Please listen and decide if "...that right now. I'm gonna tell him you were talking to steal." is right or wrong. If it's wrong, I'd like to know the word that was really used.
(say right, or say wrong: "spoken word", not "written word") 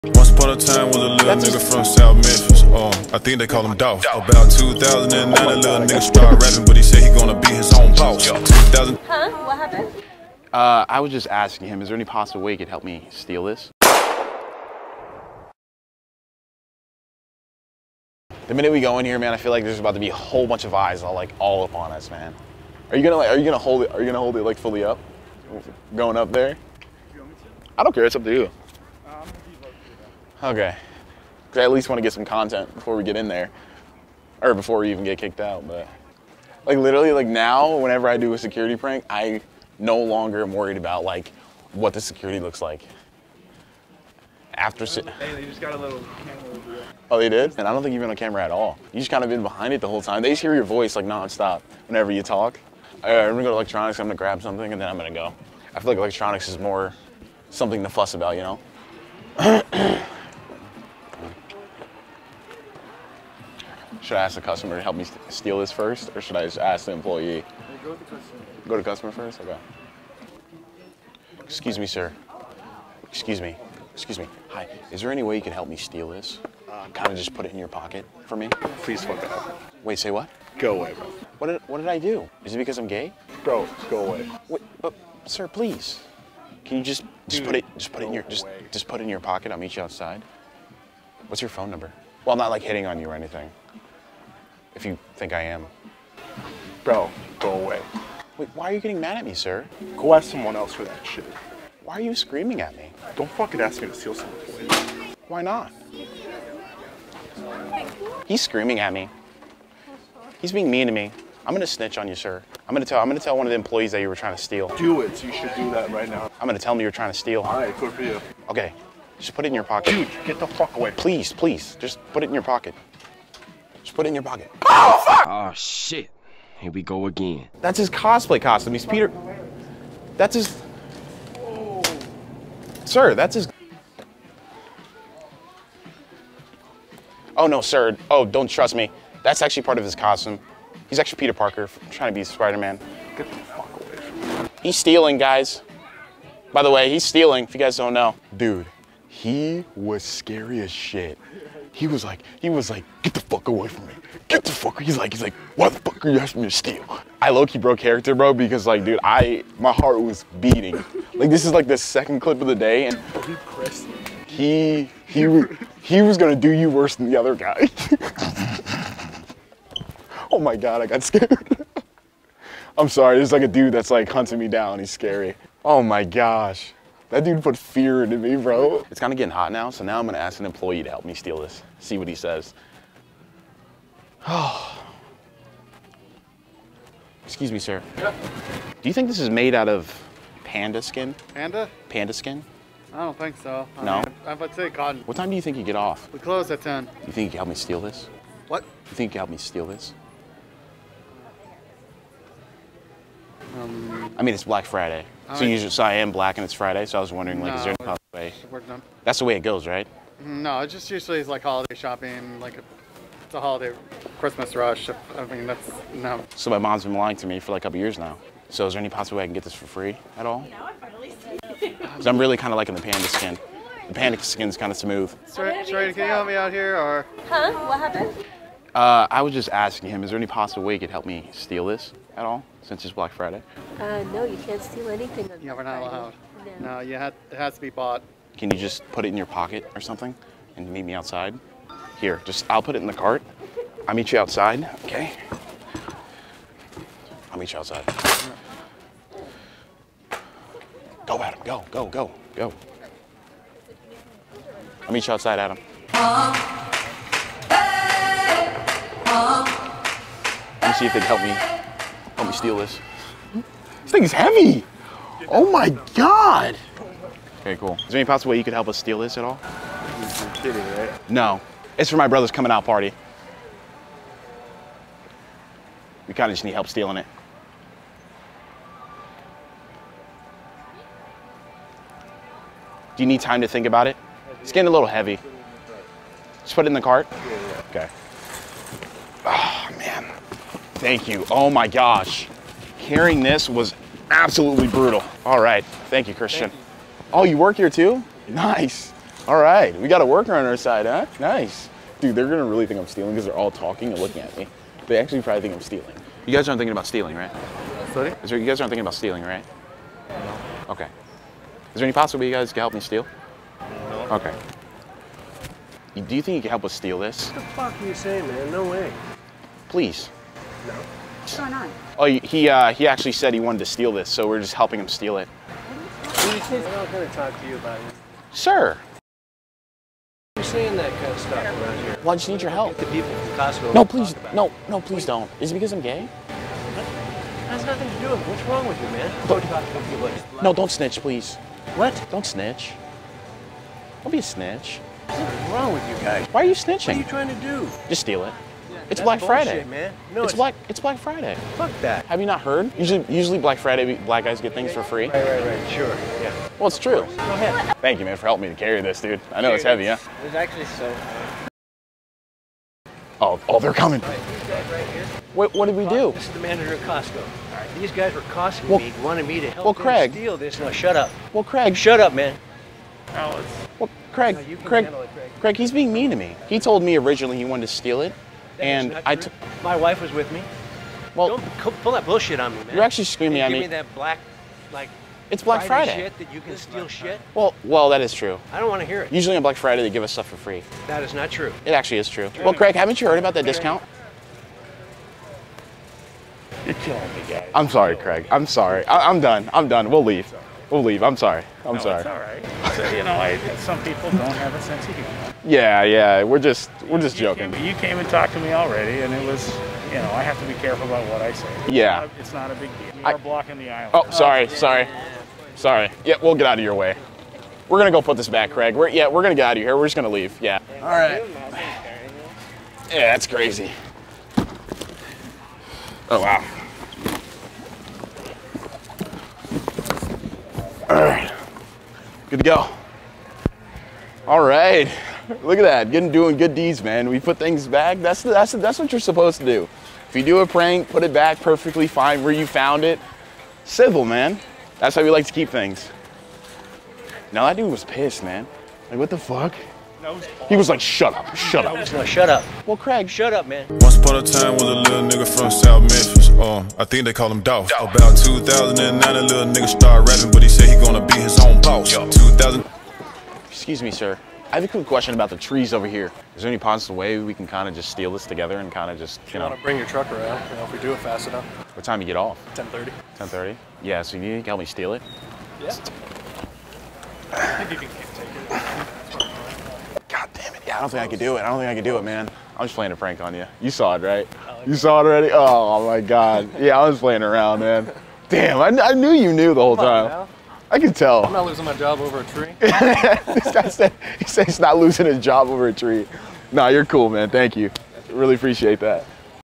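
wrong: "trying", not "talking".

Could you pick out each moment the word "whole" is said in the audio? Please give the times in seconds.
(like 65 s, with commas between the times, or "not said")
20 s, 49 s, 489 s.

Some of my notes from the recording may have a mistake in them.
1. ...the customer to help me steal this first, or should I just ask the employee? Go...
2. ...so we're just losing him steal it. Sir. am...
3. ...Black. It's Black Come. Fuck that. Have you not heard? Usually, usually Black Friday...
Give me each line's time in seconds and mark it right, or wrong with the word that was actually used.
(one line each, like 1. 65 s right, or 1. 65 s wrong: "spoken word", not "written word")
1. 64 s right
2. 324 s wrong: "helping", not "losing"
3. 350 s wrong: "Friday", not "Come".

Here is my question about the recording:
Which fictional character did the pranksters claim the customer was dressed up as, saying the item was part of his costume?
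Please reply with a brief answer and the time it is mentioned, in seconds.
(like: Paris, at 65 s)
Peter Parker, at 141 s.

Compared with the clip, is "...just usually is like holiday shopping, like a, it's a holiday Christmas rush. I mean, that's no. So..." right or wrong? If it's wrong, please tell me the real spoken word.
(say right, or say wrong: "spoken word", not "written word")
right.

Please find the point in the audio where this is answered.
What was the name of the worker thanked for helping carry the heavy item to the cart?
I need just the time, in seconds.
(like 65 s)
296 s.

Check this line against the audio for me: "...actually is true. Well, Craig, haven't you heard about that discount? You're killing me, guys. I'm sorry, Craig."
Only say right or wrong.
right.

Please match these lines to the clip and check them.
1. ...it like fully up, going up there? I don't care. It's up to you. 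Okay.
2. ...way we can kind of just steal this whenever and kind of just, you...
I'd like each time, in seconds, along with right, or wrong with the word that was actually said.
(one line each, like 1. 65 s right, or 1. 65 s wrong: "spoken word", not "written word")
1. 24 s right
2. 466 s wrong: "together", not "whenever".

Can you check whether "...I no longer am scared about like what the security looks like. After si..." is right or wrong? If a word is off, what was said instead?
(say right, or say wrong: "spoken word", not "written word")
wrong: "worried", not "scared".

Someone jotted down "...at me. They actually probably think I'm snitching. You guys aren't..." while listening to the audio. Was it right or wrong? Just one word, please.
wrong.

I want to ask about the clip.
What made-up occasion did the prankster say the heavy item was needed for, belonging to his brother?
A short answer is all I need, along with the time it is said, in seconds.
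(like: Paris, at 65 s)
Coming out party, at 272 s.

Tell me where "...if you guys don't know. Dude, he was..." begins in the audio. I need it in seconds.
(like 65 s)
147 s.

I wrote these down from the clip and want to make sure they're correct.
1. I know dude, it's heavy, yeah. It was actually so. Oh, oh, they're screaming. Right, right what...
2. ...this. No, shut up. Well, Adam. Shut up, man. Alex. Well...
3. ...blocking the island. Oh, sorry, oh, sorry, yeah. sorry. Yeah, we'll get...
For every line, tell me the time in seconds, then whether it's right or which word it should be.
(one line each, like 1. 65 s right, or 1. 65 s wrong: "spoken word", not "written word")
1. 359 s wrong: "coming", not "screaming"
2. 370 s wrong: "Craig", not "Adam"
3. 413 s right.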